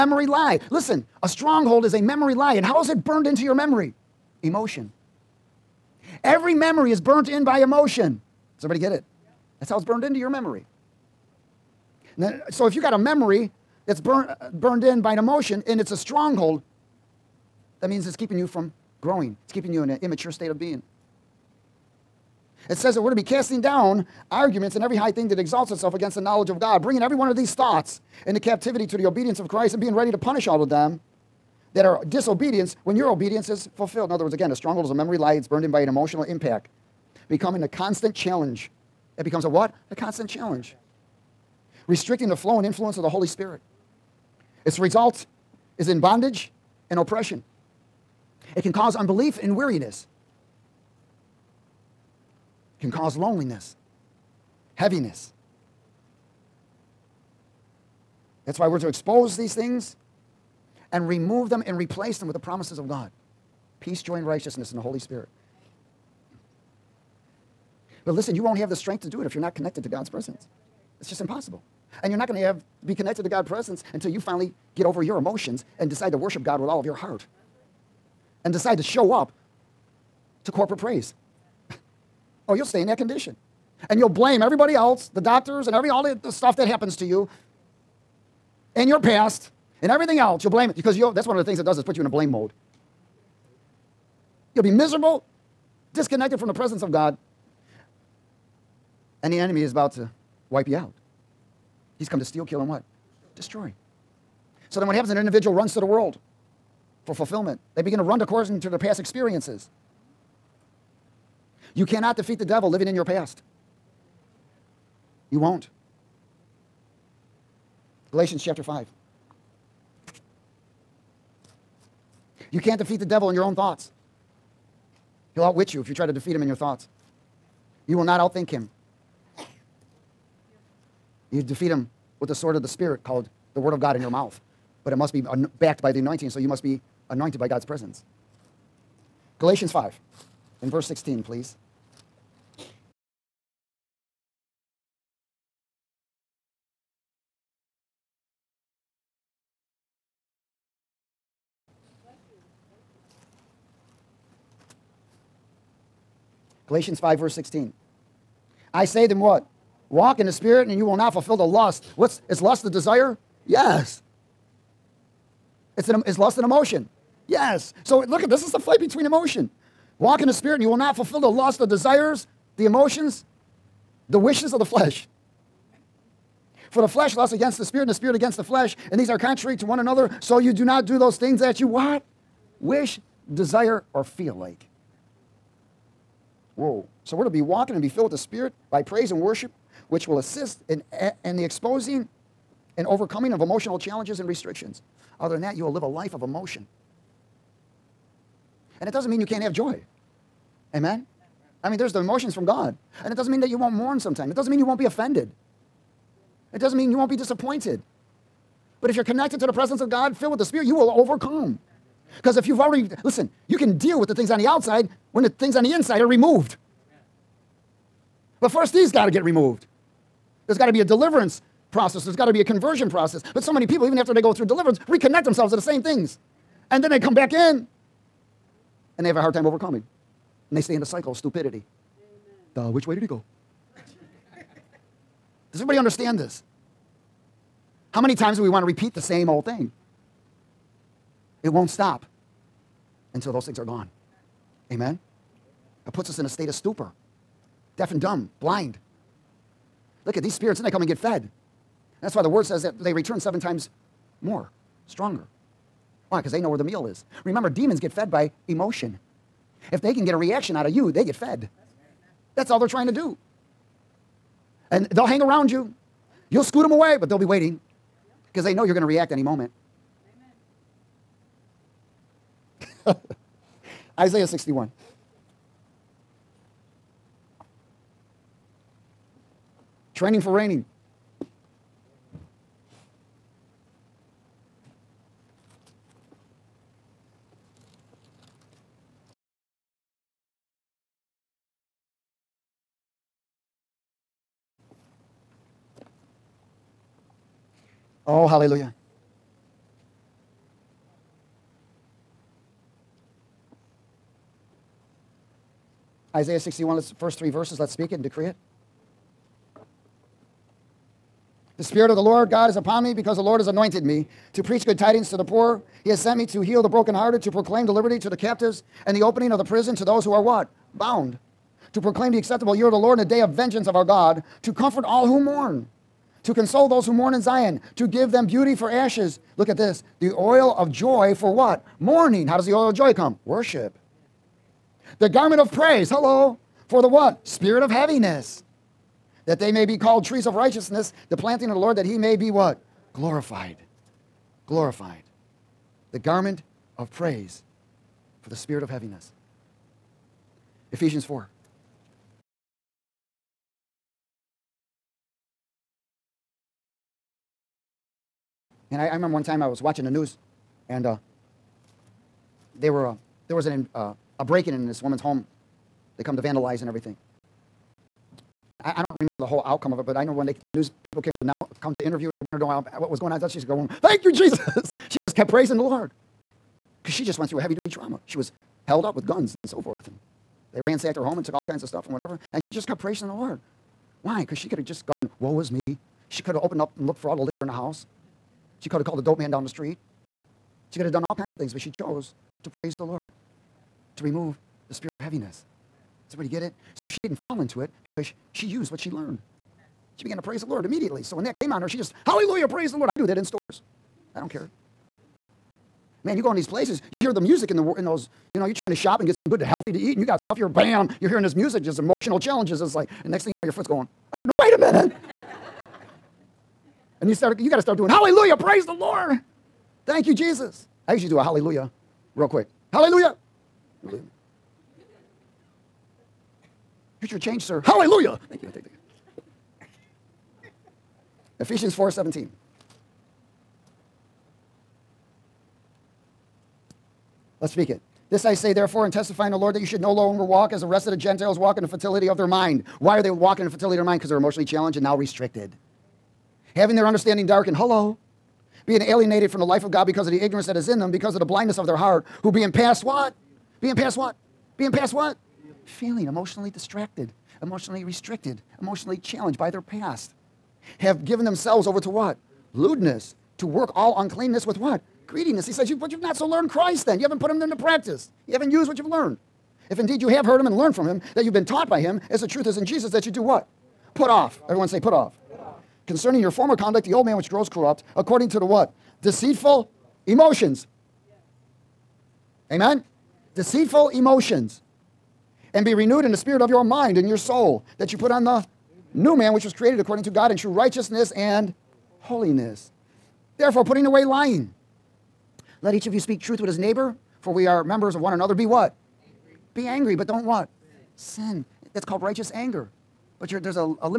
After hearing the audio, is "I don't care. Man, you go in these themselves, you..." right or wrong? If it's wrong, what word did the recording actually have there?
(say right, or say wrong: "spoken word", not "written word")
wrong: "places", not "themselves".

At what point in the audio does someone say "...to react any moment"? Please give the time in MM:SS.
04:28.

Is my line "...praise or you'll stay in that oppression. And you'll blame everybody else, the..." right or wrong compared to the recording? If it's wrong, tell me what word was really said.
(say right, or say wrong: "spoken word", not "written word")
wrong: "condition", not "oppression".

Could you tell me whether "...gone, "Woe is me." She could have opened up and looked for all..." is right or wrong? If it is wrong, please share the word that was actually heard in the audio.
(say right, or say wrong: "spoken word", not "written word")
right.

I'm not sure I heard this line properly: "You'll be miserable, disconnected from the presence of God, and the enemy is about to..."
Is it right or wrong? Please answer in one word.
right.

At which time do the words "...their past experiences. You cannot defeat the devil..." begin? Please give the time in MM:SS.
01:48.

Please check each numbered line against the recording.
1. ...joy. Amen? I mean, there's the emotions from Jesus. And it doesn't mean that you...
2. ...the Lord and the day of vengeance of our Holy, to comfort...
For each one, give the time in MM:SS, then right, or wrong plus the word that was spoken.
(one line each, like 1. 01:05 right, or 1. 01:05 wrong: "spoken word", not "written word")
1. 03:19 wrong: "God", not "Jesus"
2. 05:22 wrong: "God", not "Holy".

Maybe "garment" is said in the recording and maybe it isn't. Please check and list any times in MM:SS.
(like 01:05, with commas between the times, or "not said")
05:35, 05:45.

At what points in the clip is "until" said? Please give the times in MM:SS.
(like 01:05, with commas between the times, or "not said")
01:13, 04:03.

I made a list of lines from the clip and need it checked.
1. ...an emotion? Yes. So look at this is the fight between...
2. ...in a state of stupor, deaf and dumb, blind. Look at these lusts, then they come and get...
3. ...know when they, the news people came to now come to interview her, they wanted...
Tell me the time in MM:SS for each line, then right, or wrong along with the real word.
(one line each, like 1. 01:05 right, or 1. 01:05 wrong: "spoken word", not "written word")
1. 02:46 right
2. 04:06 wrong: "spirits", not "lusts"
3. 06:10 right.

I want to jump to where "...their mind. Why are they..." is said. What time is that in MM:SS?
07:22.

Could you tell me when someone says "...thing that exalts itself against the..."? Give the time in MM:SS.
00:25.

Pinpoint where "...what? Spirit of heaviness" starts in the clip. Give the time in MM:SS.
05:36.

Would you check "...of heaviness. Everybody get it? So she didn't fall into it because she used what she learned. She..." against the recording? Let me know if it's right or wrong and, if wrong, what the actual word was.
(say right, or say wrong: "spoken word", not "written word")
right.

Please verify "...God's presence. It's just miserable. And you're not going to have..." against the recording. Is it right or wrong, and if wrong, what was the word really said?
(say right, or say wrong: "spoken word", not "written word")
wrong: "impossible", not "miserable".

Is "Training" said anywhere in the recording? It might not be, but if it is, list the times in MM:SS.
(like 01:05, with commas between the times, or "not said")
04:39.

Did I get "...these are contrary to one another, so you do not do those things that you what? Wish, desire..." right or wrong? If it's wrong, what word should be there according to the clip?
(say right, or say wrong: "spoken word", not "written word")
right.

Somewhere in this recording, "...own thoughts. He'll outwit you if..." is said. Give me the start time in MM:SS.
02:03.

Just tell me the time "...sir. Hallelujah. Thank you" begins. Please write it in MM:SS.
07:07.